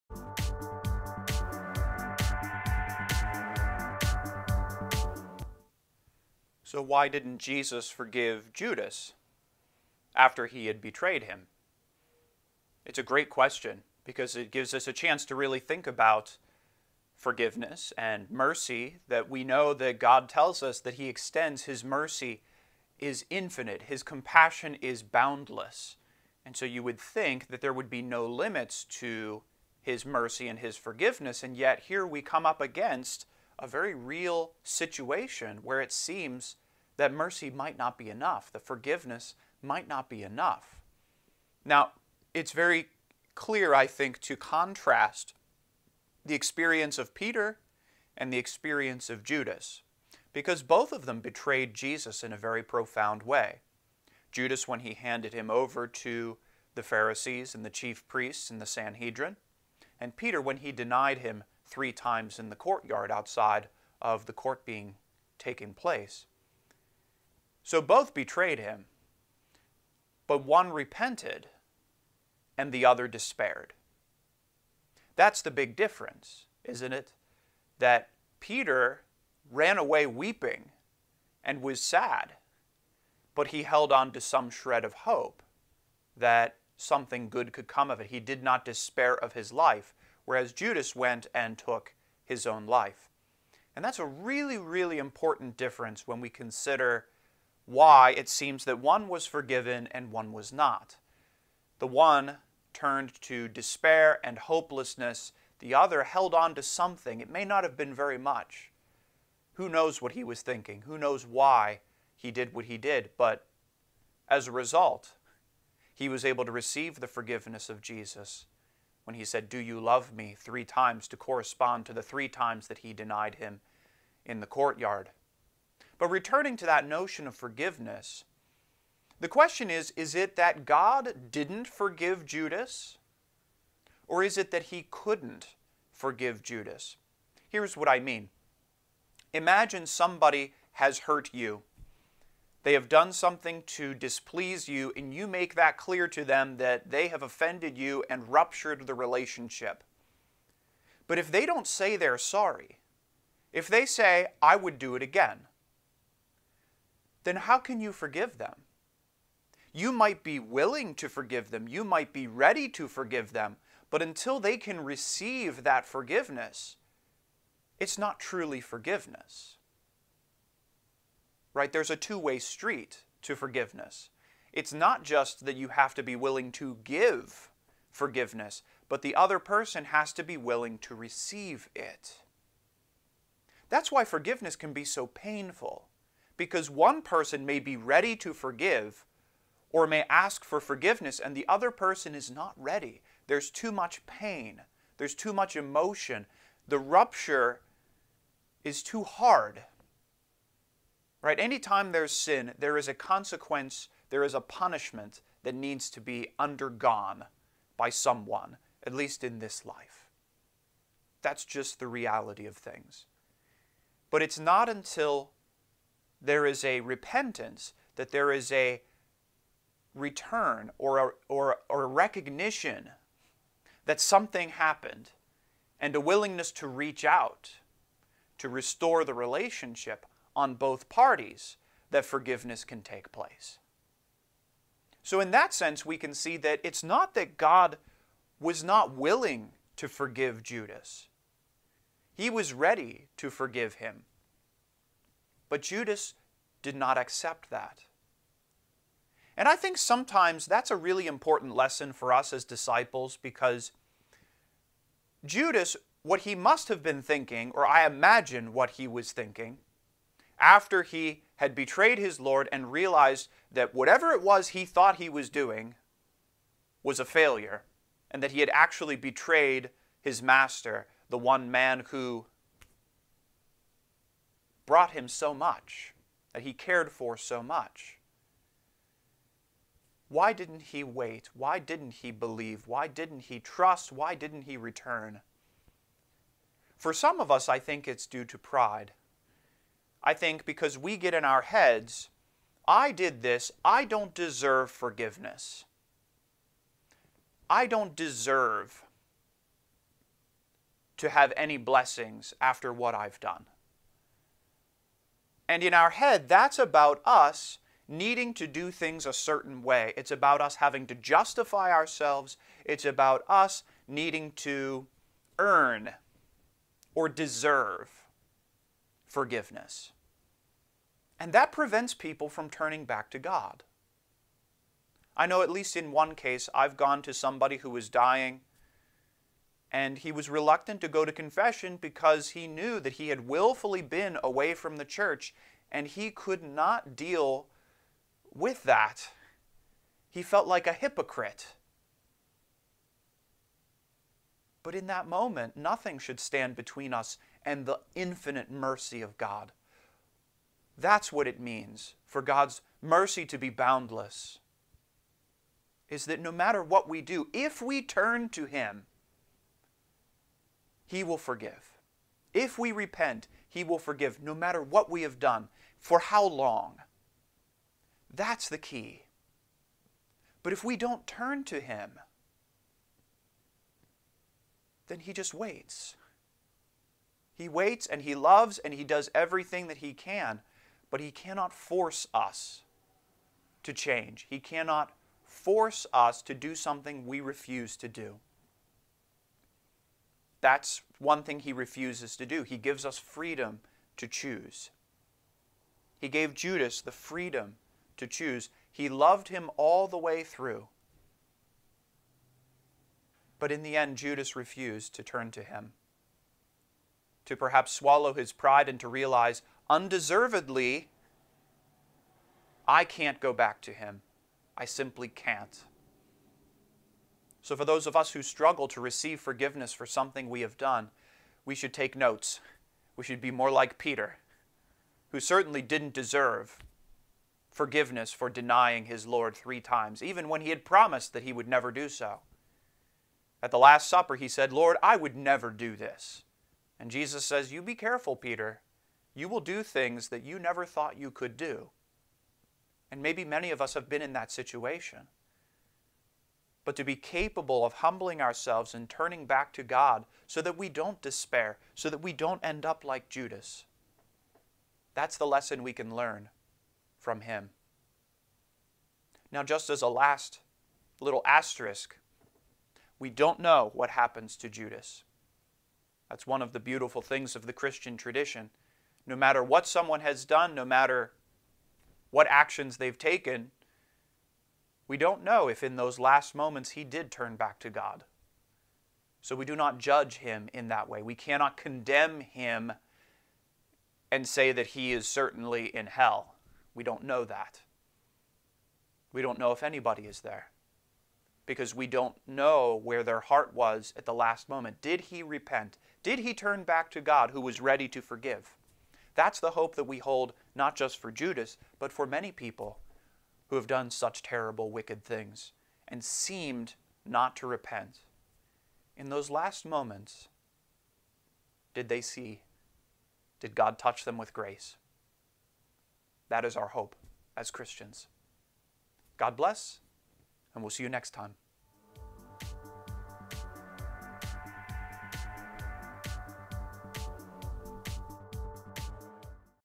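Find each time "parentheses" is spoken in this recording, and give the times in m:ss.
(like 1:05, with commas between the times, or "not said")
not said.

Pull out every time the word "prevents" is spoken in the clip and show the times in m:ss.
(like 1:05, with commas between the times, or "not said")
5:21.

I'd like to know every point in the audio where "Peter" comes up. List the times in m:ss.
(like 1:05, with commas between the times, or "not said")
0:47, 1:00, 1:18, 7:03, 7:18.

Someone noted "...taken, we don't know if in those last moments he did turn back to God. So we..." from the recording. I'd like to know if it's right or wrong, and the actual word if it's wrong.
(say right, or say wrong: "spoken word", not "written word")
right.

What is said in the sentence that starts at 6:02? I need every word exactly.
If we repent, He will forgive no matter what we have done, for how long.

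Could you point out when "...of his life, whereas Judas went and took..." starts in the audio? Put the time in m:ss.
1:29.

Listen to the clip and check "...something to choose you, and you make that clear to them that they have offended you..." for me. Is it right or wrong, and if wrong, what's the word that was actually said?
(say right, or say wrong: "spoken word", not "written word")
wrong: "displease", not "choose".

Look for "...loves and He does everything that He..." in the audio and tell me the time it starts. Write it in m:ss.
6:18.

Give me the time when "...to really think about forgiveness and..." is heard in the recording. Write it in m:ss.
0:15.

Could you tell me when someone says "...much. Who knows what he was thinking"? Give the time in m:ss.
1:48.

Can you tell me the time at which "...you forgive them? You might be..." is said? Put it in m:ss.
2:37.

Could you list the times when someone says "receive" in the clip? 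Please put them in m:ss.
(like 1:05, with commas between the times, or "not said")
1:56, 2:44, 3:00, 6:58.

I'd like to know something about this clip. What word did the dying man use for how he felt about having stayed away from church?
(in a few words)
Hypocrite.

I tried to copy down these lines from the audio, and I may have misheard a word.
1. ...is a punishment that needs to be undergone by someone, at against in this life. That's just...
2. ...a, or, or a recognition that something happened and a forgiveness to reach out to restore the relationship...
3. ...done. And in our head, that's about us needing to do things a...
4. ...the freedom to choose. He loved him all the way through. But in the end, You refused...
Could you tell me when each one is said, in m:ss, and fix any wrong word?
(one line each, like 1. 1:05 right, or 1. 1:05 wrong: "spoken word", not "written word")
1. 3:24 wrong: "least", not "against"
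2. 3:40 wrong: "willingness", not "forgiveness"
3. 5:03 right
4. 6:36 wrong: "Judas", not "You".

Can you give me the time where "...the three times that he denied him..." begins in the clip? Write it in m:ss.
2:01.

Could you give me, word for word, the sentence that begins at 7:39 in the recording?
Now, just as a last little asterisk, we don't know what happens to Judas.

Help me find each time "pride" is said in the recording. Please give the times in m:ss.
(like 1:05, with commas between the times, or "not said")
4:48, 6:48.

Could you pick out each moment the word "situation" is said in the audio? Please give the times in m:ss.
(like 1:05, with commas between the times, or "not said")
0:34, 7:24.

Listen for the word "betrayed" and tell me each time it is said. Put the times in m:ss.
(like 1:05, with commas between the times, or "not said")
0:10, 0:51, 1:08, 4:21, 4:28.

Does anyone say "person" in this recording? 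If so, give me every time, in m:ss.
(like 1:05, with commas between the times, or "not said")
2:59, 3:07, 3:11.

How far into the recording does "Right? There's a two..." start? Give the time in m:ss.
2:51.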